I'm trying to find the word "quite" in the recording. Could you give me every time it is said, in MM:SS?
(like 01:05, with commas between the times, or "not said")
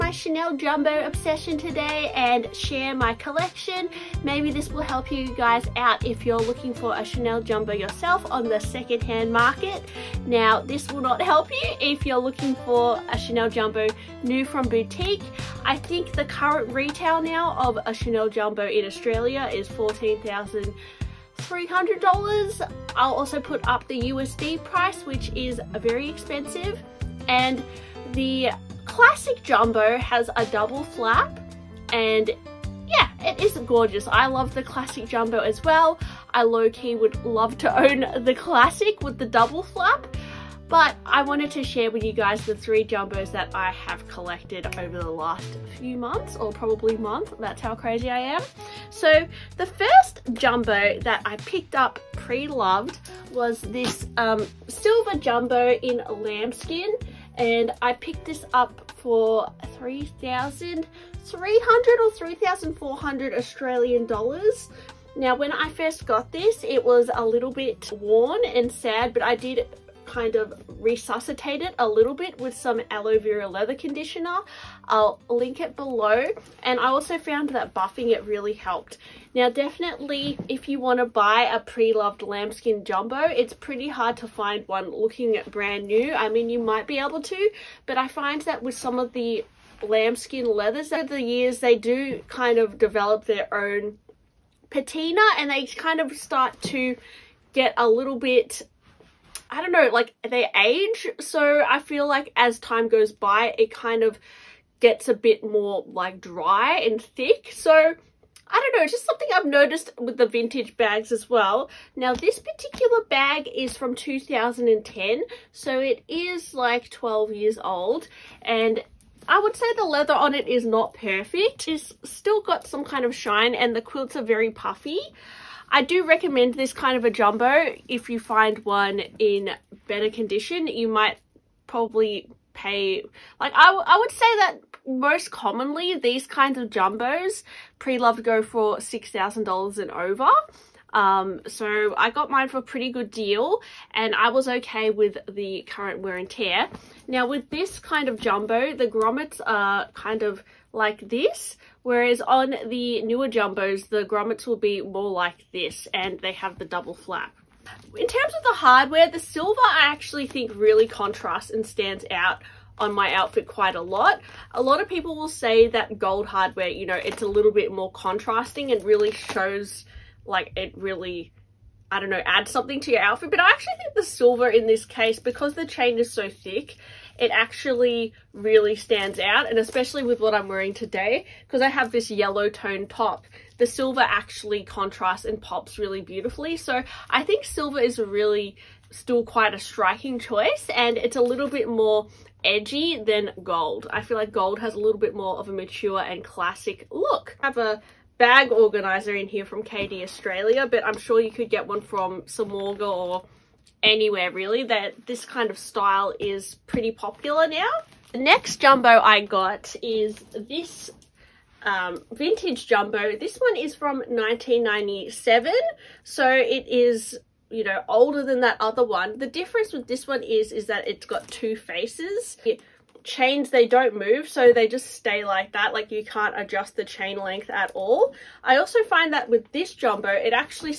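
02:43, 03:09.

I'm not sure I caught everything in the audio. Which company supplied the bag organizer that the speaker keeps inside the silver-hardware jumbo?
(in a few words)
KD Australia.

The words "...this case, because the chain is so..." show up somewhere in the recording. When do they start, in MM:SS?
02:54.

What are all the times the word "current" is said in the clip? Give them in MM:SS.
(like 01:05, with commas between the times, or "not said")
00:16, 02:25.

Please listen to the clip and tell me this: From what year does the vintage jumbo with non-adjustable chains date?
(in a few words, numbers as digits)
1997.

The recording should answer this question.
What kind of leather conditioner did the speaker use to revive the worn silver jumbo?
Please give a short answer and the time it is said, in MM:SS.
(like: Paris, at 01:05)
aloe vera, at 01:12.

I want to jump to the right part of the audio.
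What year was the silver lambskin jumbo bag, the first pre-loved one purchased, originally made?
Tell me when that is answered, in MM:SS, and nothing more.
01:53.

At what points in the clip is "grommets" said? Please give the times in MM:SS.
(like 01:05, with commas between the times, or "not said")
02:28, 02:34.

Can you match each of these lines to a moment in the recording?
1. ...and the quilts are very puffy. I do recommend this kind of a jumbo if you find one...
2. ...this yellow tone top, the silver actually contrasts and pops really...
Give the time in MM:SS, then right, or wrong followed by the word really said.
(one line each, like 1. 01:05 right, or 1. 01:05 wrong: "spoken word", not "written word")
1. 02:03 right
2. 03:01 right.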